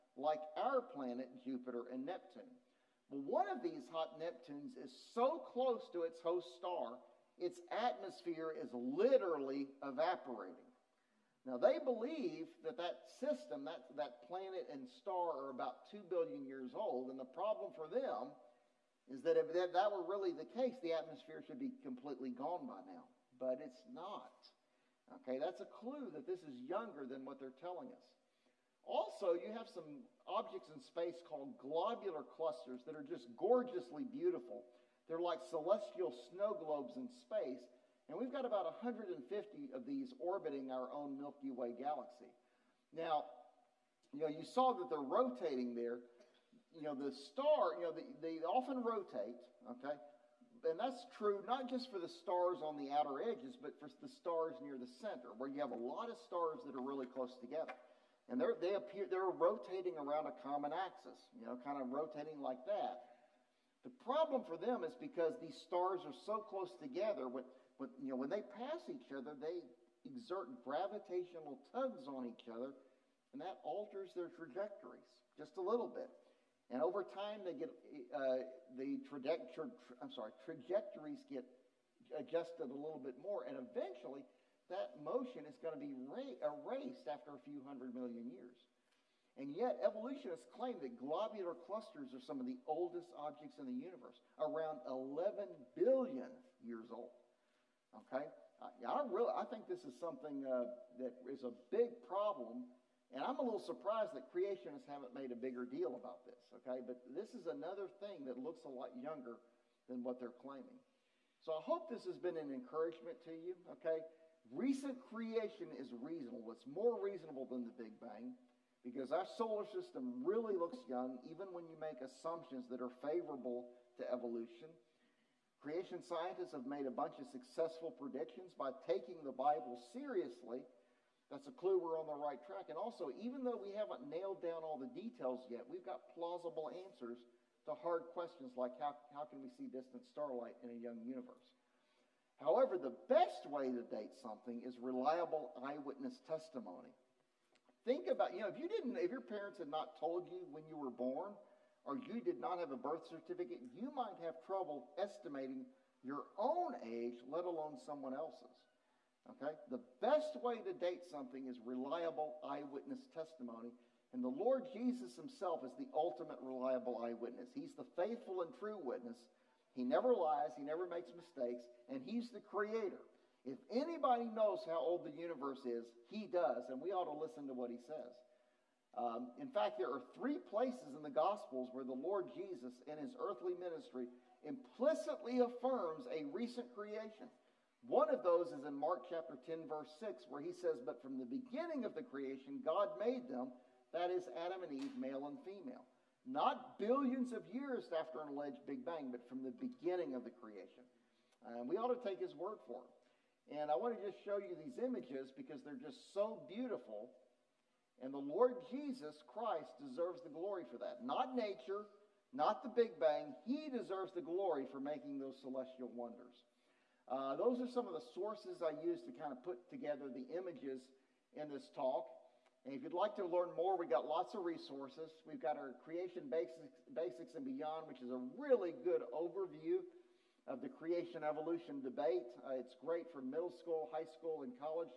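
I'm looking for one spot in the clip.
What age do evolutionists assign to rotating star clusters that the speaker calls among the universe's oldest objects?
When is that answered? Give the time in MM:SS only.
01:34.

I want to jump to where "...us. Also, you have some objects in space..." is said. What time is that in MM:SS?
00:27.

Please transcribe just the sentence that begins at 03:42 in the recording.
And if you'd like to learn more, we've got lots of resources.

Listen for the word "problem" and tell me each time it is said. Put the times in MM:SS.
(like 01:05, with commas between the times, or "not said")
00:17, 01:04, 01:42.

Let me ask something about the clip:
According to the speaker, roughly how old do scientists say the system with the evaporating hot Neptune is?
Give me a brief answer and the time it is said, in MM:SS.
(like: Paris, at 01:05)
2 billion years, at 00:15.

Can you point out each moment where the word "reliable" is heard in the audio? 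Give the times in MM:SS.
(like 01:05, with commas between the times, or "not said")
02:24, 02:41, 02:46.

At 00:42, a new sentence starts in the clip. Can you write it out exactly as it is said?
Now, you know, you saw that they're rotating there, you know, the star, you know, the, they often rotate, okay?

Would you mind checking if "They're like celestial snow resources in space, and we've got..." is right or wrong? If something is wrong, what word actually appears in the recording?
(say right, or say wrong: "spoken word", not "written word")
wrong: "globes", not "resources".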